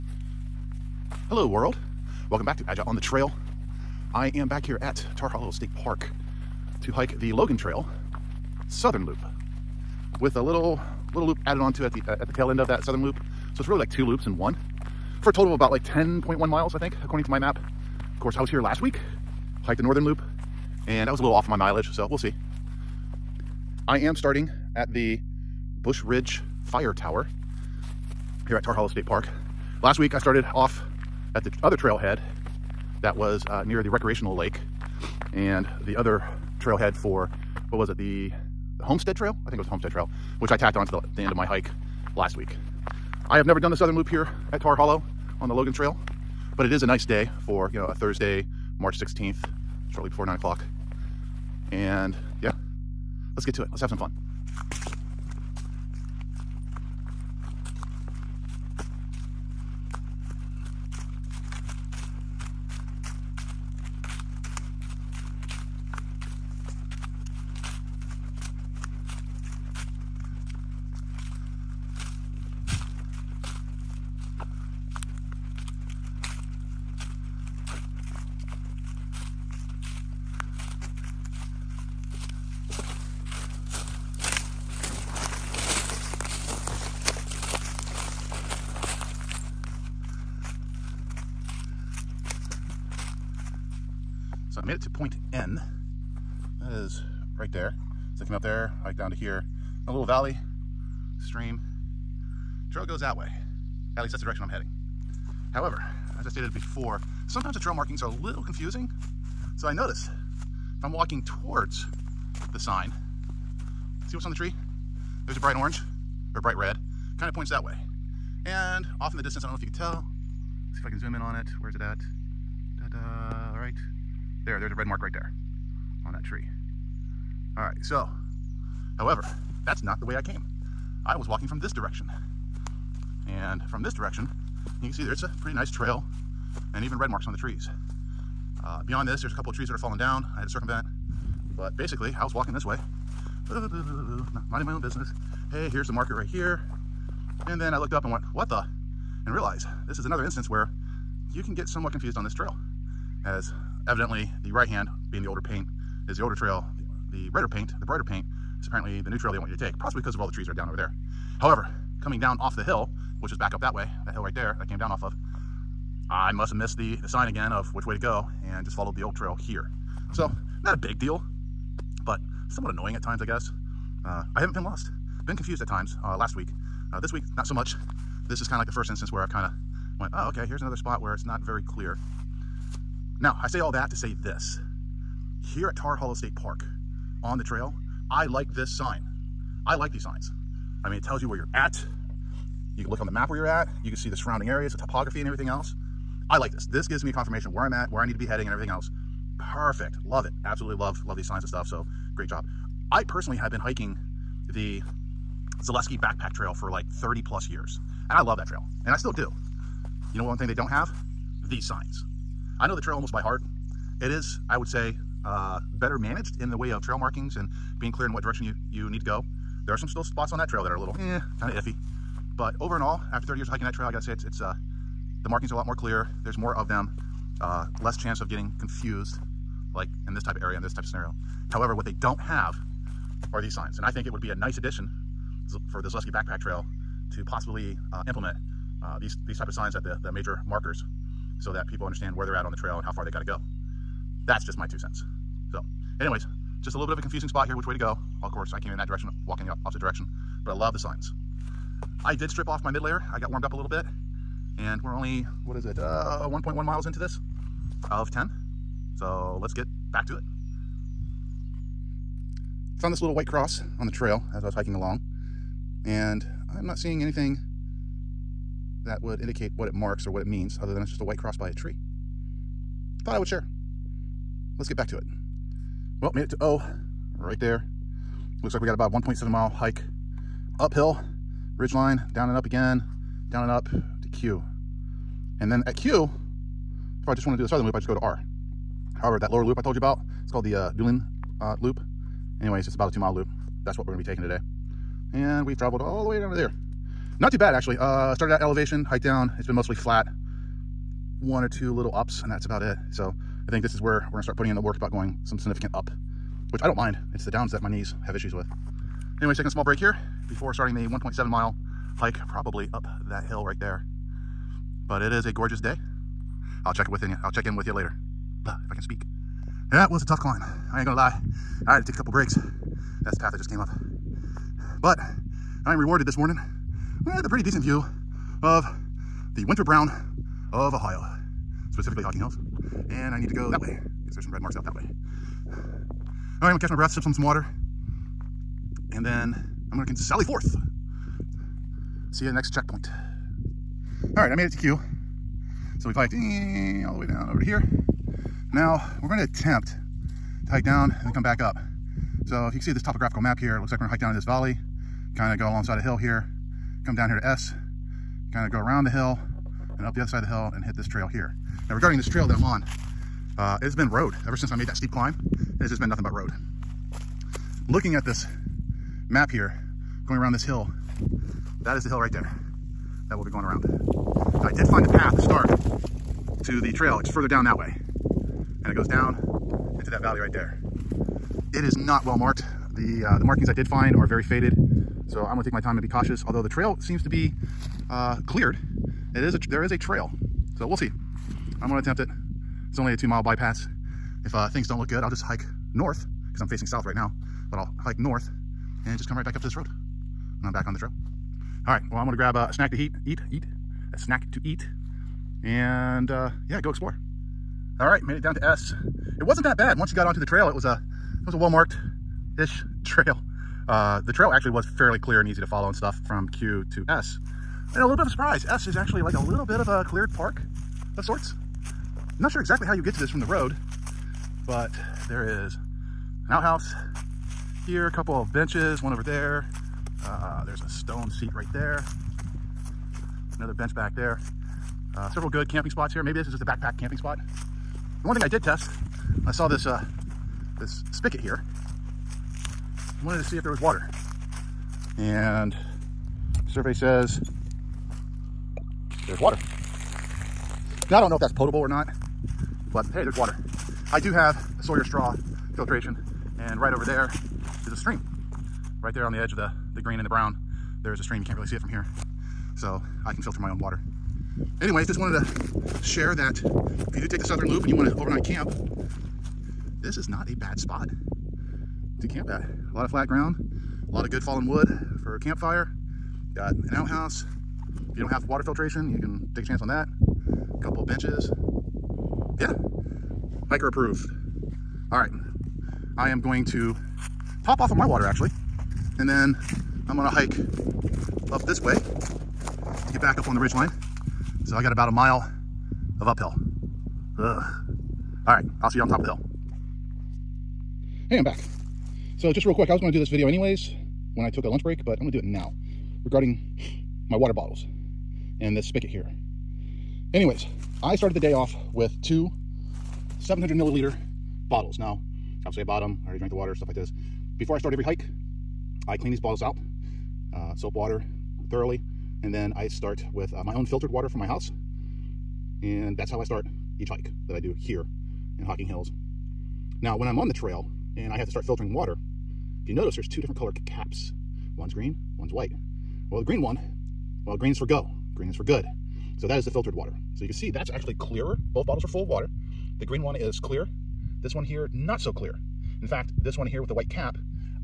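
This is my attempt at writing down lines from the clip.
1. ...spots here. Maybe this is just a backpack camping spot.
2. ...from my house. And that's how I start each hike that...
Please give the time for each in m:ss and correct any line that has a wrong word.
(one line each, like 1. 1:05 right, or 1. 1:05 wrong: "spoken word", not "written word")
1. 7:15 right
2. 8:44 right.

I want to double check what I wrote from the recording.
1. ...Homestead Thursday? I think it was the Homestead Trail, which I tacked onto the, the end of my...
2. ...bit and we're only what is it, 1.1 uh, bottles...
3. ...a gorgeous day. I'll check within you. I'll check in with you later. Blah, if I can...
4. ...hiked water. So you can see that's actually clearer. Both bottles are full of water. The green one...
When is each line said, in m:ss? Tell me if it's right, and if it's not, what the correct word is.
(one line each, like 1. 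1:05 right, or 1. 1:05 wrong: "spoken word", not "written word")
1. 0:38 wrong: "Trail", not "Thursday"
2. 4:13 wrong: "miles", not "bottles"
3. 5:15 right
4. 8:59 wrong: "filtered", not "hiked".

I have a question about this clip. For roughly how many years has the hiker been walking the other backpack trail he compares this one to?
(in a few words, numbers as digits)
30.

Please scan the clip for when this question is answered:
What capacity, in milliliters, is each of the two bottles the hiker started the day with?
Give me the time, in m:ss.
8:33.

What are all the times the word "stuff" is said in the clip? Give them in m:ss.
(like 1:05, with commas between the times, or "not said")
3:21, 6:55, 8:36.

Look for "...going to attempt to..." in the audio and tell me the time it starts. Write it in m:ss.
5:49.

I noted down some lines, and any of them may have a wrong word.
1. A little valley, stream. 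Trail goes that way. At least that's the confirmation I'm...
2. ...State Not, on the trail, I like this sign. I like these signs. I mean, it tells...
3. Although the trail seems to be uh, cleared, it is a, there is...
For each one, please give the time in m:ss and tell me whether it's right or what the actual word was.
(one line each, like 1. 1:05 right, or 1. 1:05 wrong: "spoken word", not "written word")
1. 1:39 wrong: "direction", not "confirmation"
2. 3:06 wrong: "Park", not "Not"
3. 6:26 right.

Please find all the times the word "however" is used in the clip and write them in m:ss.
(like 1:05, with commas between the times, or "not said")
1:45, 2:08, 2:41, 3:51, 4:48.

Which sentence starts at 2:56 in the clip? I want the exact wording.
Uh, this week, not so much.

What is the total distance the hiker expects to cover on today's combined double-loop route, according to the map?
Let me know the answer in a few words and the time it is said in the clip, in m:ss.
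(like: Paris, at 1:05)
10.1 miles, at 0:15.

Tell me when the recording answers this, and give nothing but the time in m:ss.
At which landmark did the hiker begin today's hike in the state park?
0:25.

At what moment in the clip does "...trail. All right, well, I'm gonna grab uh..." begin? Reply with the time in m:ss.
6:40.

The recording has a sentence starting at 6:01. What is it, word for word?
Now regarding this trail that I'm on, uh, it's been road ever since I made that steep climb.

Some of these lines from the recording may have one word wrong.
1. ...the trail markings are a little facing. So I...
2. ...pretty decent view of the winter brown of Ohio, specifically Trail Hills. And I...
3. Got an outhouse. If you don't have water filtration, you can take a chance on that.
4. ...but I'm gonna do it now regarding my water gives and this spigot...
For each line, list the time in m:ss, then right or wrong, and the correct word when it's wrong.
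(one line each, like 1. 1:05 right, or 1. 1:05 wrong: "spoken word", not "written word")
1. 1:47 wrong: "confusing", not "facing"
2. 5:27 wrong: "Hocking", not "Trail"
3. 7:56 right
4. 8:24 wrong: "bottles", not "gives".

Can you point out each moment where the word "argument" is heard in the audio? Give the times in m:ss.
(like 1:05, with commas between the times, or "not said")
not said.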